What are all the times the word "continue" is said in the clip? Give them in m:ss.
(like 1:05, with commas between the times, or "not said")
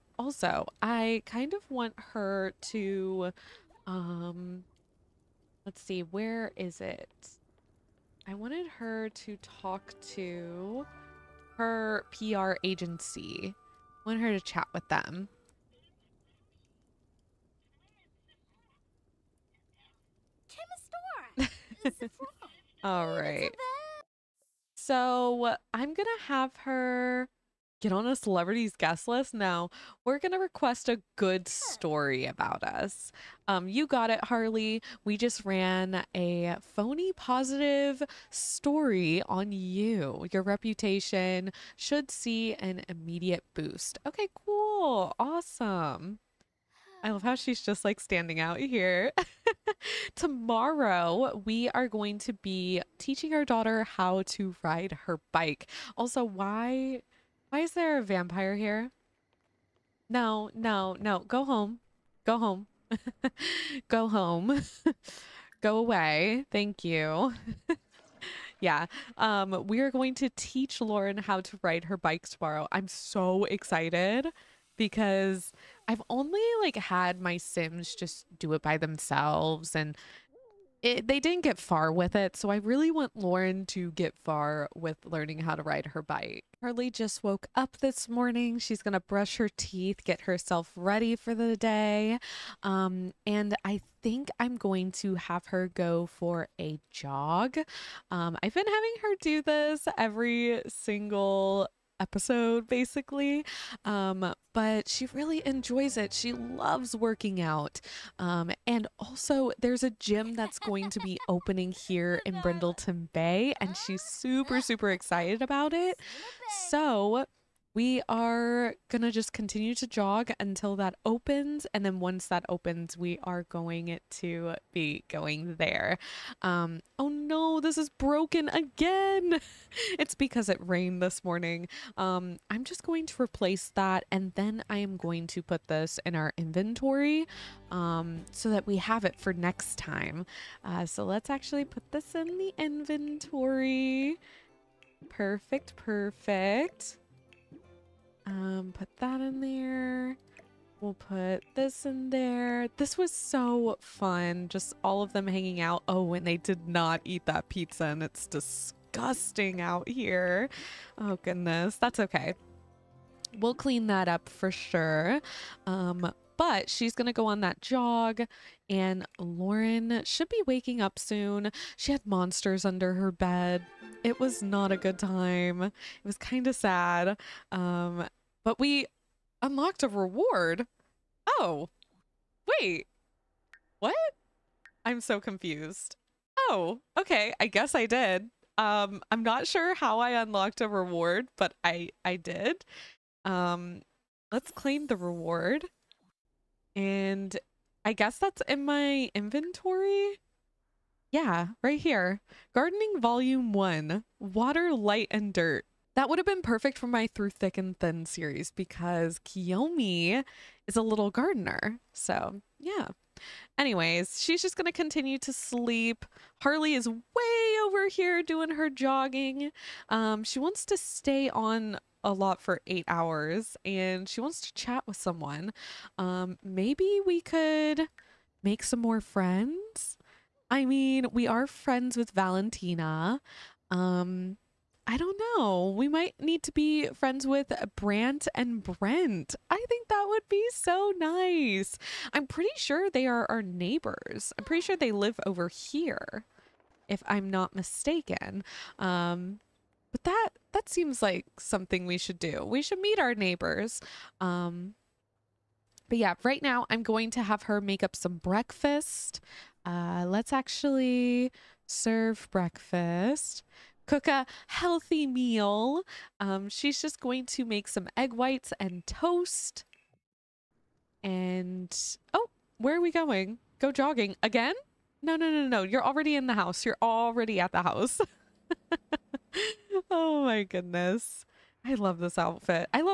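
1:59, 3:34.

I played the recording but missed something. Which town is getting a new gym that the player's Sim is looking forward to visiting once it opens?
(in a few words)
Brindleton Bay.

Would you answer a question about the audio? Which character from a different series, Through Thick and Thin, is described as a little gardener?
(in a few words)
Kiyomi.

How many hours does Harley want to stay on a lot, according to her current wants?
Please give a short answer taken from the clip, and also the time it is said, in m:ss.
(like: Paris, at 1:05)
8, at 3:42.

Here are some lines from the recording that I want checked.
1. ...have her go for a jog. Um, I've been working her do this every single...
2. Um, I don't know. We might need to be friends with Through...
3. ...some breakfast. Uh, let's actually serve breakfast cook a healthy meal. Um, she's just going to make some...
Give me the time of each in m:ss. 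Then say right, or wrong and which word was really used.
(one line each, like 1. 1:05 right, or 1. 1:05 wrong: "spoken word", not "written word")
1. 1:35 wrong: "having", not "working"
2. 3:53 wrong: "Brant", not "Through"
3. 4:17 right.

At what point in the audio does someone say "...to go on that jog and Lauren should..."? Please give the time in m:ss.
2:47.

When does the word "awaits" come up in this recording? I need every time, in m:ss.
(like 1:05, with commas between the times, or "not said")
not said.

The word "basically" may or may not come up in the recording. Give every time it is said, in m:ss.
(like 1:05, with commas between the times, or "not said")
1:42.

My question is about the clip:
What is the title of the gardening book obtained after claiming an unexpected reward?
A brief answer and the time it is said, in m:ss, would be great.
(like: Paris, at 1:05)
Gardening Volume 1, Water, Light, and Dirt, at 3:22.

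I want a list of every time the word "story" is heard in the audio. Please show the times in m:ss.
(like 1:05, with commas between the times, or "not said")
0:31, 0:38.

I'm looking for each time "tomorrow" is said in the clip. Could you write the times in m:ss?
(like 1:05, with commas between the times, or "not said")
0:50, 1:12.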